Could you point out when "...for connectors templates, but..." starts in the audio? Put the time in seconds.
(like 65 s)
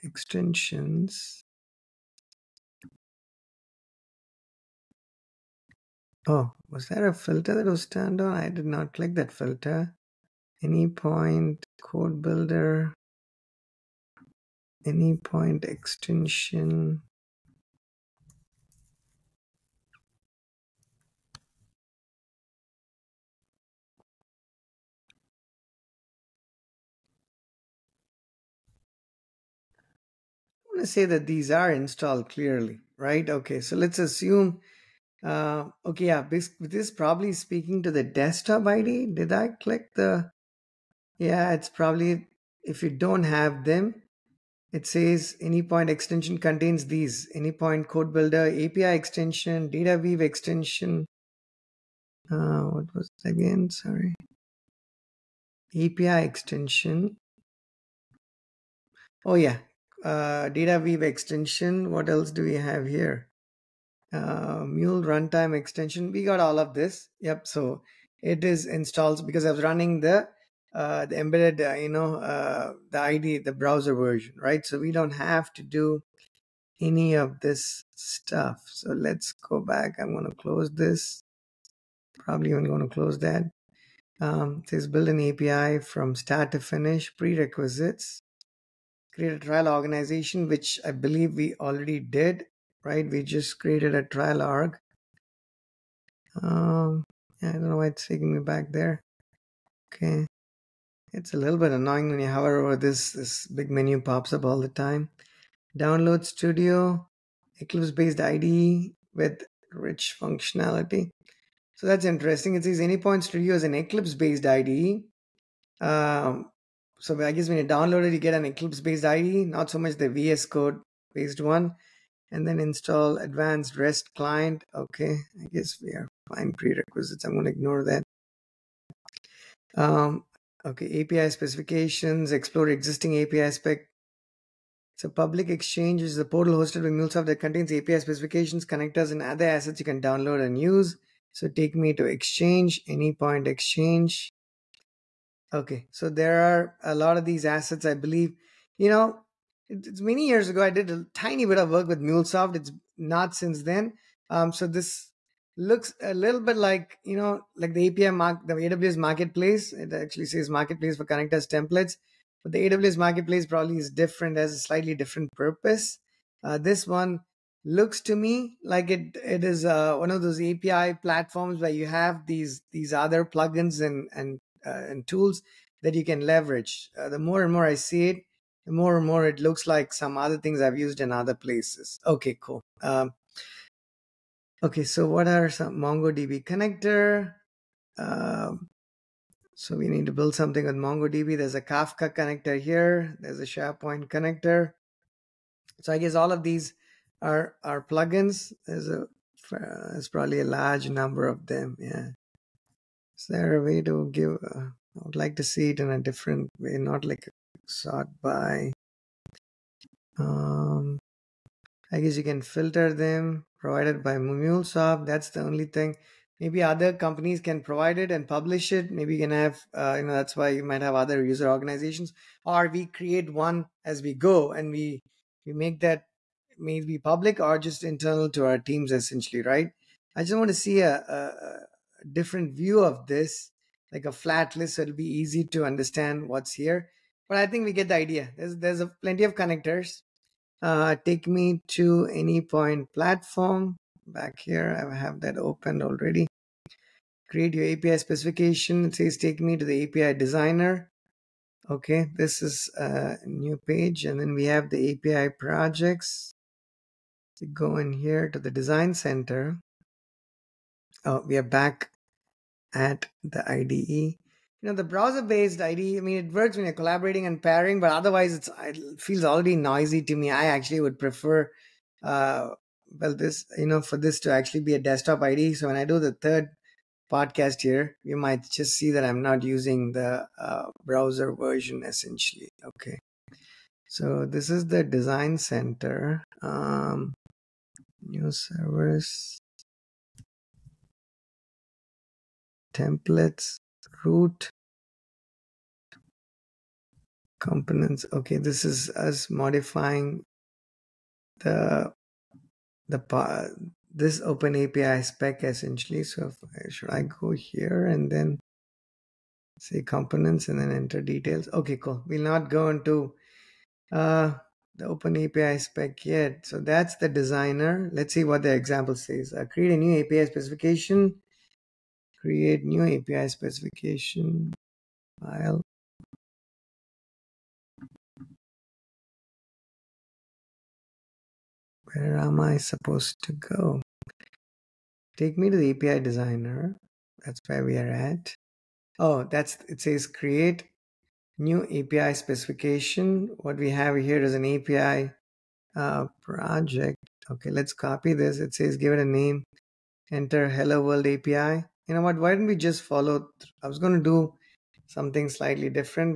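160 s.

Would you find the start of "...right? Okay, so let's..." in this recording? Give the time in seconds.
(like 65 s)
32 s.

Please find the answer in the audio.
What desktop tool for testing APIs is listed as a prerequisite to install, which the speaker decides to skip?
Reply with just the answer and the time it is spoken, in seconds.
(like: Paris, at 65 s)
Advanced REST Client, at 123 s.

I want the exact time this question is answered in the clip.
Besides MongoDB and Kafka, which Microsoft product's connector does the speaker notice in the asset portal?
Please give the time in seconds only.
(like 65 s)
193 s.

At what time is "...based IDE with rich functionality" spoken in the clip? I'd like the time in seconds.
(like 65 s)
107 s.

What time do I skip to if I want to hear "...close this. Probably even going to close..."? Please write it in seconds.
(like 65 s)
80 s.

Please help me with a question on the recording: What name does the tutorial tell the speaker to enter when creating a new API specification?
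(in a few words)
Hello World API.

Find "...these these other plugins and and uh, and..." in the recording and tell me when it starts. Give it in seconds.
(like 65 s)
172 s.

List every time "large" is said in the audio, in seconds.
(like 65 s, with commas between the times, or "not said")
200 s.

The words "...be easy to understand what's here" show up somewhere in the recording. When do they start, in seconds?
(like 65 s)
234 s.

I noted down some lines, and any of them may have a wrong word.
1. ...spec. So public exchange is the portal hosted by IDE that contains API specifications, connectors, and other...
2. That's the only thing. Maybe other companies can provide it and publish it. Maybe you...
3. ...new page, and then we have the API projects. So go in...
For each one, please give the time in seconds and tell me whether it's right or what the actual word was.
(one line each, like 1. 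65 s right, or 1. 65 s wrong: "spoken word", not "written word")
1. 133 s wrong: "MuleSoft", not "IDE"
2. 215 s right
3. 253 s right.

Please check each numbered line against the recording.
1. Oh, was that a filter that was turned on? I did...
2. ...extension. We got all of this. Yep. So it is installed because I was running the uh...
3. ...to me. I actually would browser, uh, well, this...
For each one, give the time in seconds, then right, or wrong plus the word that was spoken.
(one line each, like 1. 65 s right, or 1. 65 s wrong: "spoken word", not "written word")
1. 6 s right
2. 65 s right
3. 270 s wrong: "prefer", not "browser".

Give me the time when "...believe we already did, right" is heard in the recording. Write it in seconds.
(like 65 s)
90 s.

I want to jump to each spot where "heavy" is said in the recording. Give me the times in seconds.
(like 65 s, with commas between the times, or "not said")
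not said.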